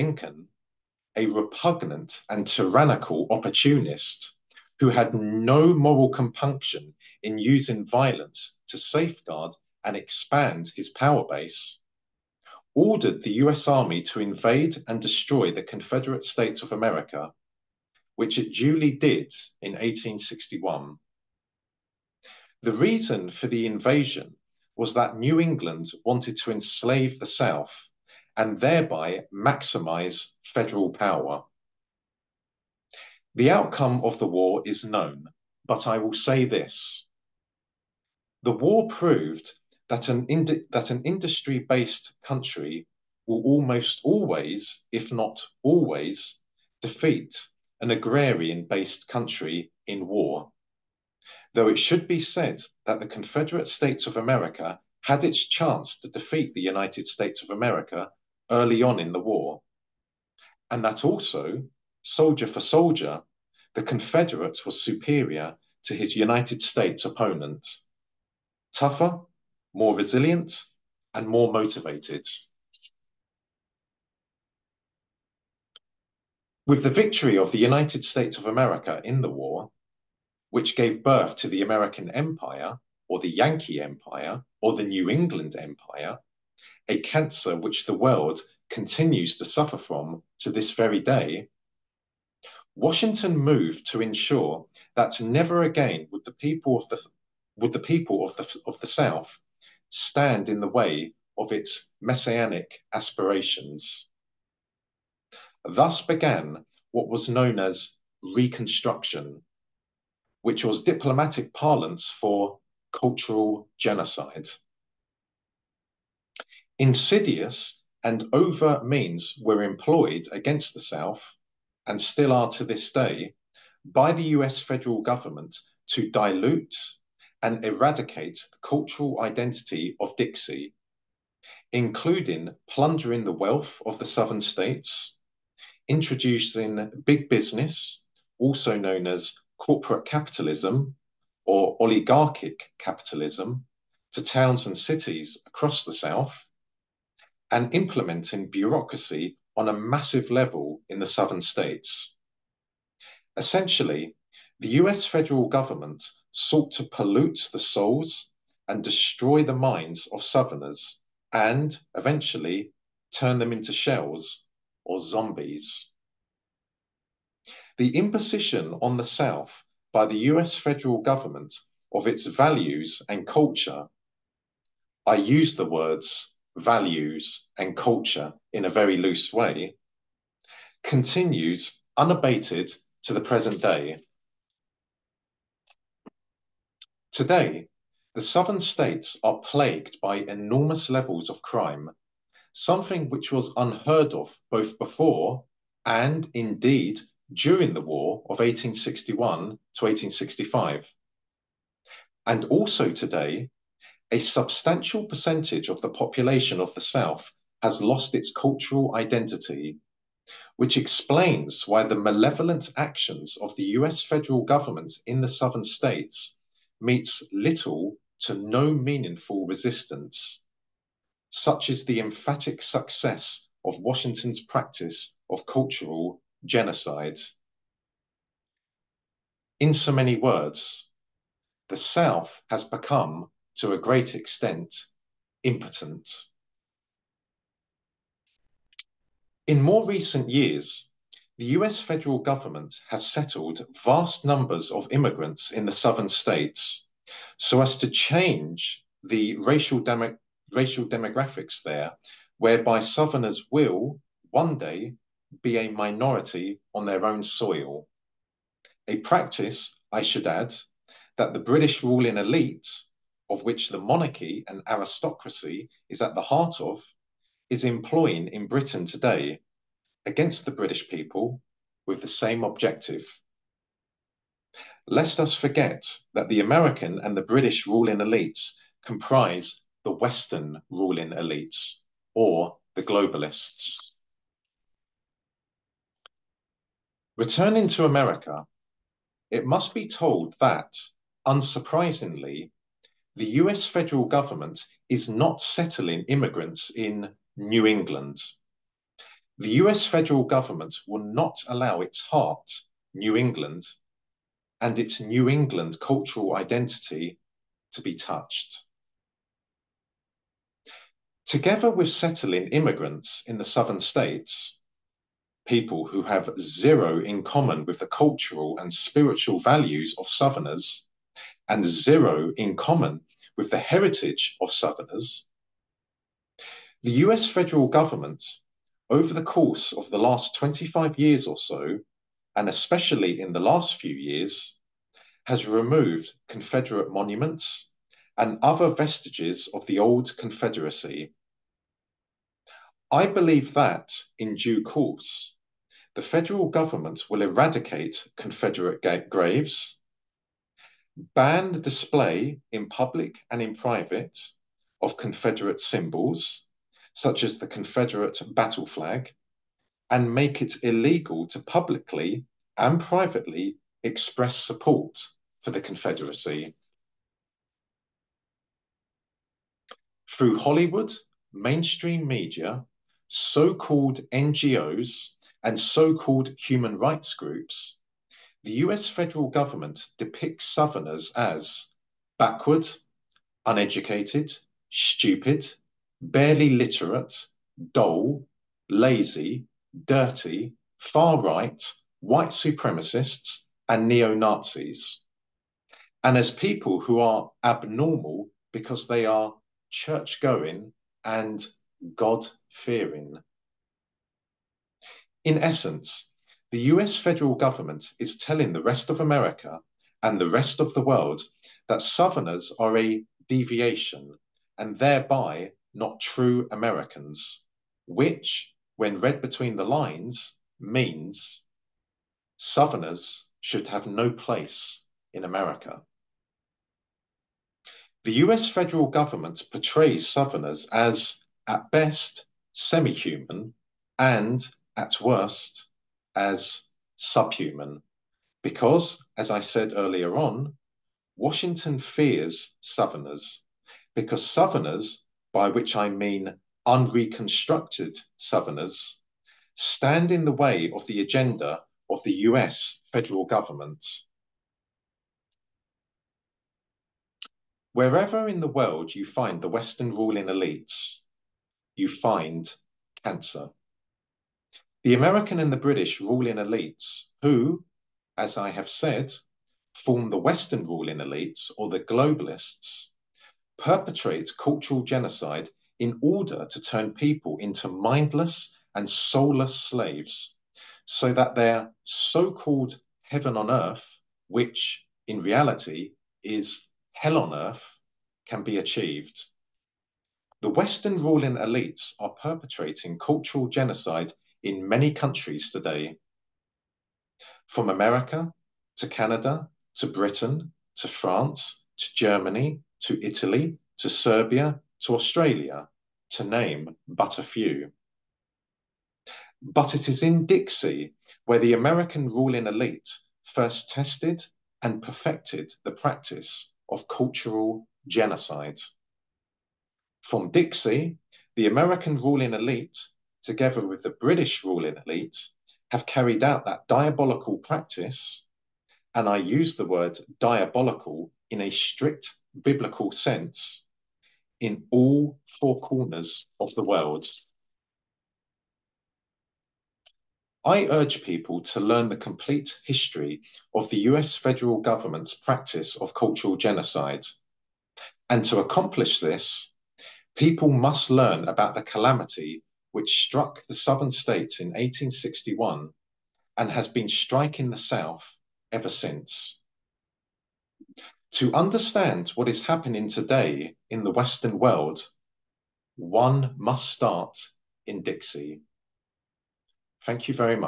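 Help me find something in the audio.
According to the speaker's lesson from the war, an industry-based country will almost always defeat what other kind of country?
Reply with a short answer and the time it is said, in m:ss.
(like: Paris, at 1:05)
Agrarian based country, at 0:47.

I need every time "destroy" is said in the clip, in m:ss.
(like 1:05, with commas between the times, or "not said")
0:14, 2:38.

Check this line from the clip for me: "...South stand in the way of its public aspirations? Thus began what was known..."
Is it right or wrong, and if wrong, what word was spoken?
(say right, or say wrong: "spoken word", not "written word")
wrong: "messianic", not "public".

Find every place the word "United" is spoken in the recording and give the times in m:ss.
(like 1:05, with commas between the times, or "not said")
0:56, 1:06, 1:17.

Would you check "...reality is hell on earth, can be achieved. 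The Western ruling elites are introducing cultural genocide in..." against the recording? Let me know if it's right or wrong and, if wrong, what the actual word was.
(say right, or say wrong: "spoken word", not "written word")
wrong: "perpetrating", not "introducing".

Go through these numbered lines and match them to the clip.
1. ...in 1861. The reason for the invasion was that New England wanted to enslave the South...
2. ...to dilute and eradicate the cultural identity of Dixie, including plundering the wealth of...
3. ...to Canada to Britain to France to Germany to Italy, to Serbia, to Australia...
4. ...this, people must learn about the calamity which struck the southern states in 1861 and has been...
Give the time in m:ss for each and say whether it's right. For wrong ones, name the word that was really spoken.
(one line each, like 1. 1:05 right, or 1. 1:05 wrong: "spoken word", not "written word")
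1. 0:19 right
2. 2:05 right
3. 8:18 right
4. 9:08 right.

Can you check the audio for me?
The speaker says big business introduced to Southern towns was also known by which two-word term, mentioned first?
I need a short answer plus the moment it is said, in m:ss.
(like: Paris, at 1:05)
Corporate capitalism, at 2:19.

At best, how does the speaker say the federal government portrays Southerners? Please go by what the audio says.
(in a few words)
Semi human.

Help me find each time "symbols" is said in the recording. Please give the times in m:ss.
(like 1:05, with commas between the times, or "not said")
5:55.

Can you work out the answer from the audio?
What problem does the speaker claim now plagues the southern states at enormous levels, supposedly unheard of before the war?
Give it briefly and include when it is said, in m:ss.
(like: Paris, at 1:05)
Crime, at 3:11.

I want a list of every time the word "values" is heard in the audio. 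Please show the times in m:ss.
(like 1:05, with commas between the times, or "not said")
2:52, 2:56, 5:19.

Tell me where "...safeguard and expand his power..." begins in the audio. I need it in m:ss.
0:08.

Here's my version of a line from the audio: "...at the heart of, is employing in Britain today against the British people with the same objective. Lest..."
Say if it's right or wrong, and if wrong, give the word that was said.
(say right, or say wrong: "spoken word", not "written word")
right.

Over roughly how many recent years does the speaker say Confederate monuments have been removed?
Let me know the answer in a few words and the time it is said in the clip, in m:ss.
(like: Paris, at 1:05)
25 years, at 5:30.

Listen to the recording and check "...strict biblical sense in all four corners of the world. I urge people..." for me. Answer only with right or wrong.
right.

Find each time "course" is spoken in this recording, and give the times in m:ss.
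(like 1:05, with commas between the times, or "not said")
5:29, 5:44.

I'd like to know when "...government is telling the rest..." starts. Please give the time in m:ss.
6:47.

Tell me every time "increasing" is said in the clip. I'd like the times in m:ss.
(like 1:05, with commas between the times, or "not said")
not said.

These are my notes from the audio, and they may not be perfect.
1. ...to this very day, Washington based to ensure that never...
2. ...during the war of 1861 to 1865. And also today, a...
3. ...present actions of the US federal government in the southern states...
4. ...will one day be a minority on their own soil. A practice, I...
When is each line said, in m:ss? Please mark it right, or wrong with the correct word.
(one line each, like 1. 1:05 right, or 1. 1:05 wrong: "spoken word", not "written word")
1. 1:30 wrong: "moved", not "based"
2. 3:17 right
3. 3:31 wrong: "malevolent", not "present"
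4. 4:13 right.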